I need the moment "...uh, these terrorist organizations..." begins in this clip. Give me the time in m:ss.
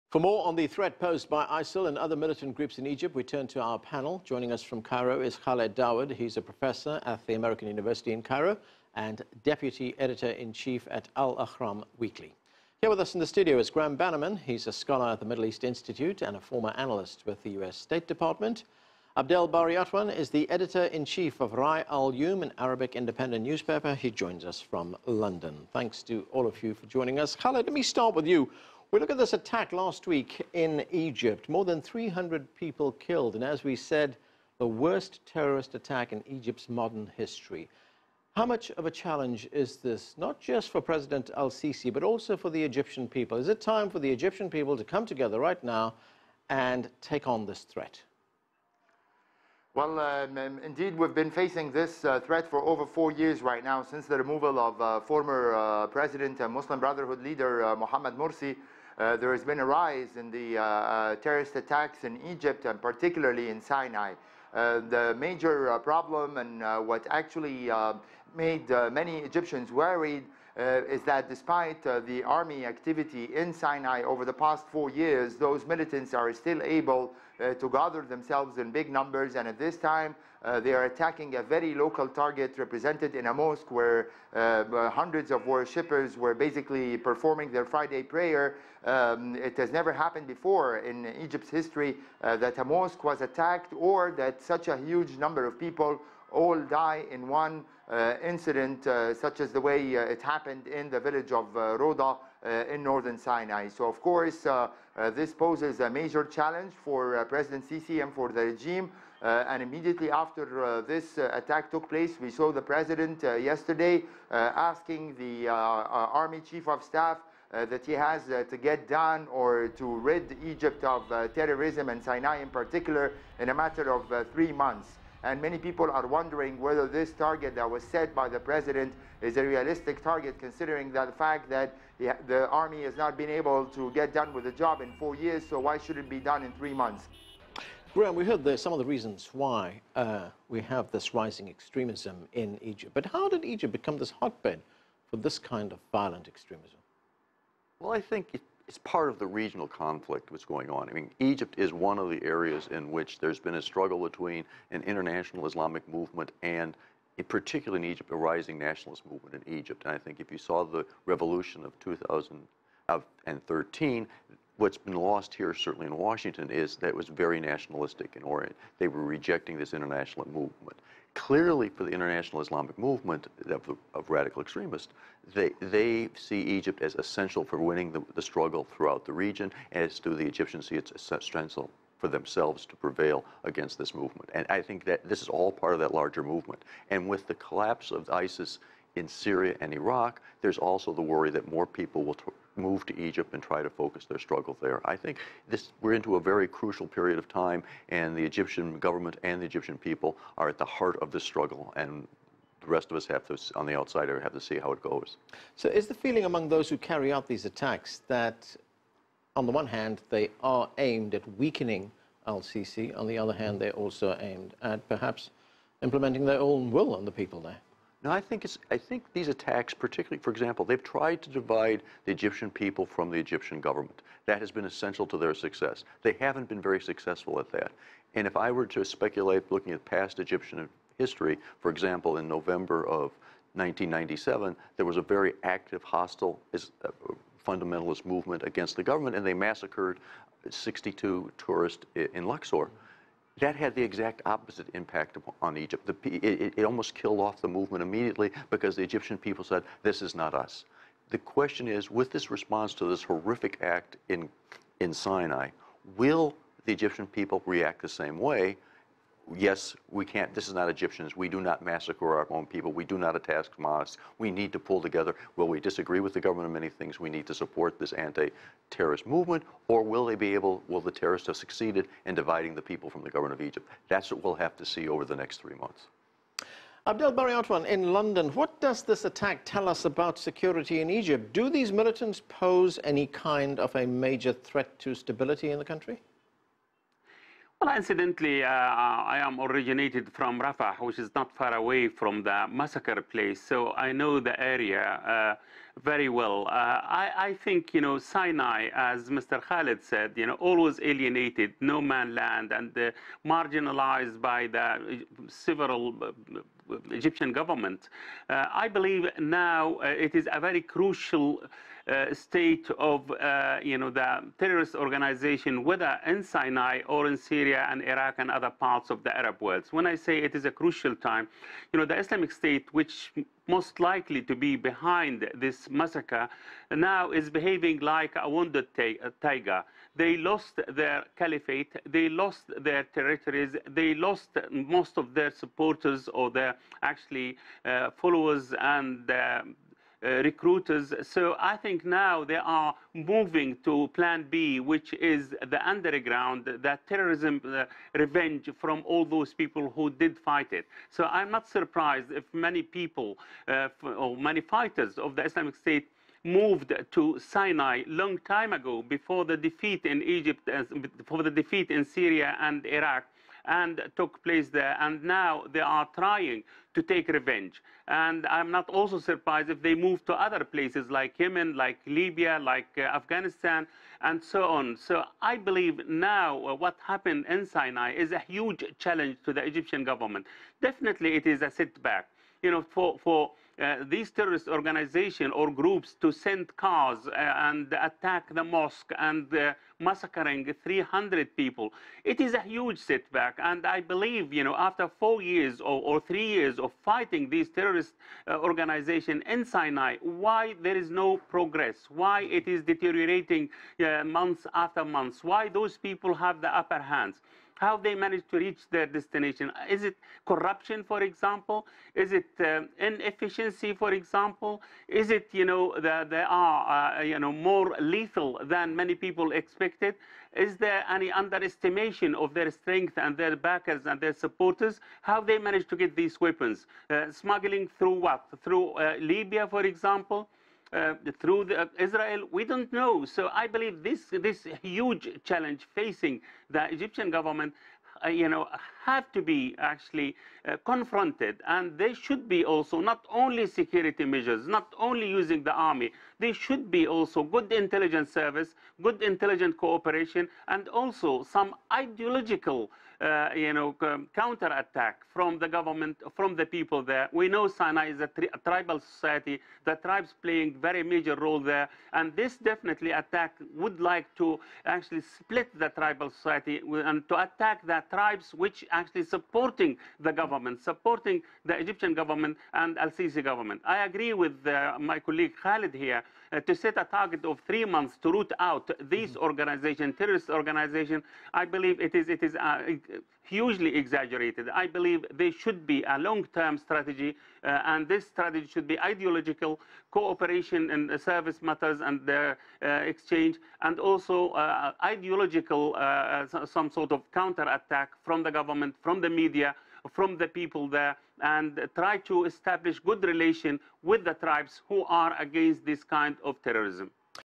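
6:23.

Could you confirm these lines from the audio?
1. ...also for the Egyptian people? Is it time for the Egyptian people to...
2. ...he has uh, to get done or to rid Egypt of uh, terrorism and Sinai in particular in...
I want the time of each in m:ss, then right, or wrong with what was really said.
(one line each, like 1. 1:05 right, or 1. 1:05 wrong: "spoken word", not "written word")
1. 0:42 right
2. 1:57 right.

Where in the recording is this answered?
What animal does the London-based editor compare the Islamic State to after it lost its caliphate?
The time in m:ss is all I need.
5:28.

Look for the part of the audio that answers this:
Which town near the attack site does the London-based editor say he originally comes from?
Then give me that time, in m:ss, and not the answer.
4:50.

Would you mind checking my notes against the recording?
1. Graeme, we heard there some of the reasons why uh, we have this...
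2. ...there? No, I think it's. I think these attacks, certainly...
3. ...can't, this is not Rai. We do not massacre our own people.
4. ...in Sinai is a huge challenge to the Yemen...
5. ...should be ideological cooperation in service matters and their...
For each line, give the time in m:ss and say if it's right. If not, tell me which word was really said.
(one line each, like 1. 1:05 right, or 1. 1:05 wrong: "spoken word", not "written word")
1. 2:17 right
2. 3:37 wrong: "particularly", not "certainly"
3. 4:20 wrong: "Egyptians", not "Rai"
4. 6:17 wrong: "Egyptian", not "Yemen"
5. 8:08 right.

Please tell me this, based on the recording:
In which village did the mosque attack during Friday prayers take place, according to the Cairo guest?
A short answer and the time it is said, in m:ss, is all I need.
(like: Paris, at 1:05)
Roda, at 1:41.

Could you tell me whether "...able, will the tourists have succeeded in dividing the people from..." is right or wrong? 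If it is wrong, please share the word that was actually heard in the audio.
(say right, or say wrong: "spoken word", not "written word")
wrong: "terrorists", not "tourists".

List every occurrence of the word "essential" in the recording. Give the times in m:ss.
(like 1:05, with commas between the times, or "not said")
2:56, 3:01, 3:44.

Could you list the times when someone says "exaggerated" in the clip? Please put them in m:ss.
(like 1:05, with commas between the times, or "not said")
8:03.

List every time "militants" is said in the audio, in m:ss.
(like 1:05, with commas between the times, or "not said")
0:02, 1:15, 4:41.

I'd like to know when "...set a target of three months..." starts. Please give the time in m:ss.
7:56.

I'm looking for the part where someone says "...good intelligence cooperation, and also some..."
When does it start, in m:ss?
7:28.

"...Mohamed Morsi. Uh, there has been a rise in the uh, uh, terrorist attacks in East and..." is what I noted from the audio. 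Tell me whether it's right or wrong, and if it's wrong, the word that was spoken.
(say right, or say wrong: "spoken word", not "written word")
wrong: "Egypt", not "East".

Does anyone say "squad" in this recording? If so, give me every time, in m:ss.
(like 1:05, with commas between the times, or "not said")
not said.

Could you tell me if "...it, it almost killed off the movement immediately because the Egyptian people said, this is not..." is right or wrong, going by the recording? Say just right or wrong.
right.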